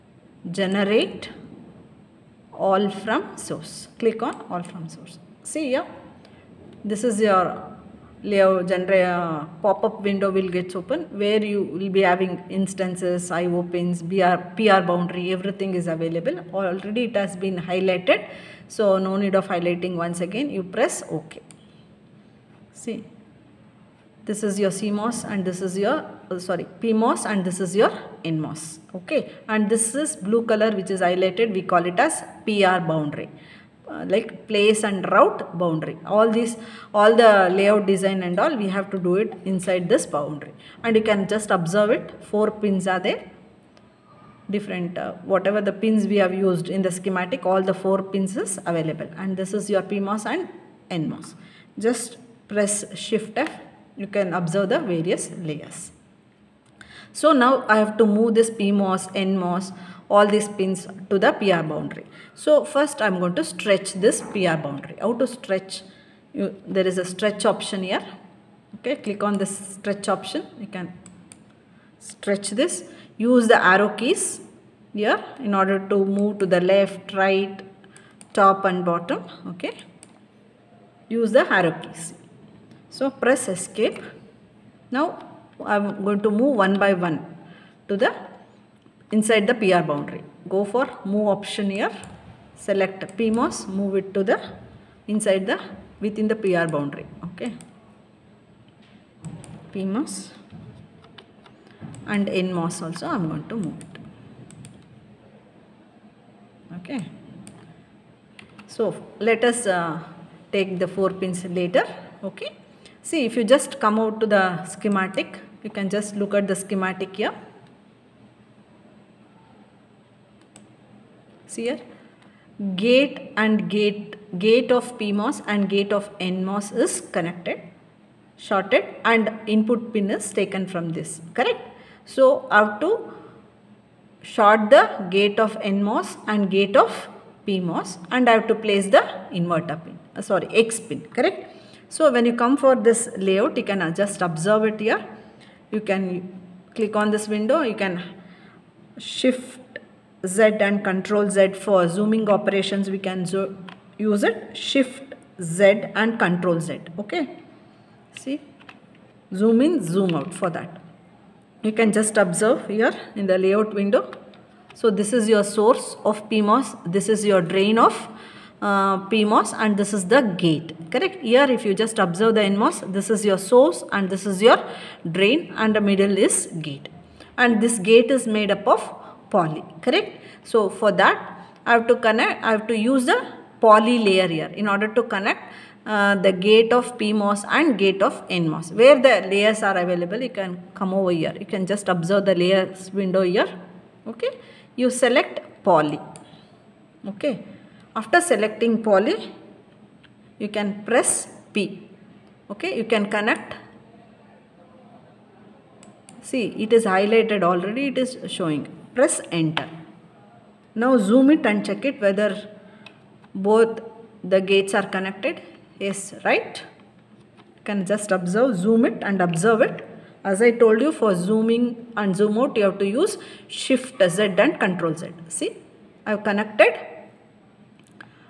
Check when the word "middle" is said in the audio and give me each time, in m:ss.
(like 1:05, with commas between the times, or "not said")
2:55.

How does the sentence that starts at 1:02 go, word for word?
So first I'm going to stretch this PR boundary.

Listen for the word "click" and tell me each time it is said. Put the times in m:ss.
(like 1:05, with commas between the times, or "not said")
0:04, 1:08, 2:26.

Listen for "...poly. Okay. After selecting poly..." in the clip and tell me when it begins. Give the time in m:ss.
3:15.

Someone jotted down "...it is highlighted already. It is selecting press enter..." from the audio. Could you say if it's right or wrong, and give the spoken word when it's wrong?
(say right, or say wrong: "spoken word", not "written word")
wrong: "showing", not "selecting".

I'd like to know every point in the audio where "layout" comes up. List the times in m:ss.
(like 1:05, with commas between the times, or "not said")
0:08, 0:37, 2:23, 2:43.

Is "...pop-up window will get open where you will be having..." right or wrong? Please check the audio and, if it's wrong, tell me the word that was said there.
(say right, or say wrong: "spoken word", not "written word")
right.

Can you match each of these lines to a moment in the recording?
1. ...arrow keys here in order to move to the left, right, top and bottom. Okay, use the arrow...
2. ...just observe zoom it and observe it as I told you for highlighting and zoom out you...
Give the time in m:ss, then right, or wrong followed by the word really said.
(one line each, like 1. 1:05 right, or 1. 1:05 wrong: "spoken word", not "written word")
1. 1:13 right
2. 3:37 wrong: "zooming", not "highlighting".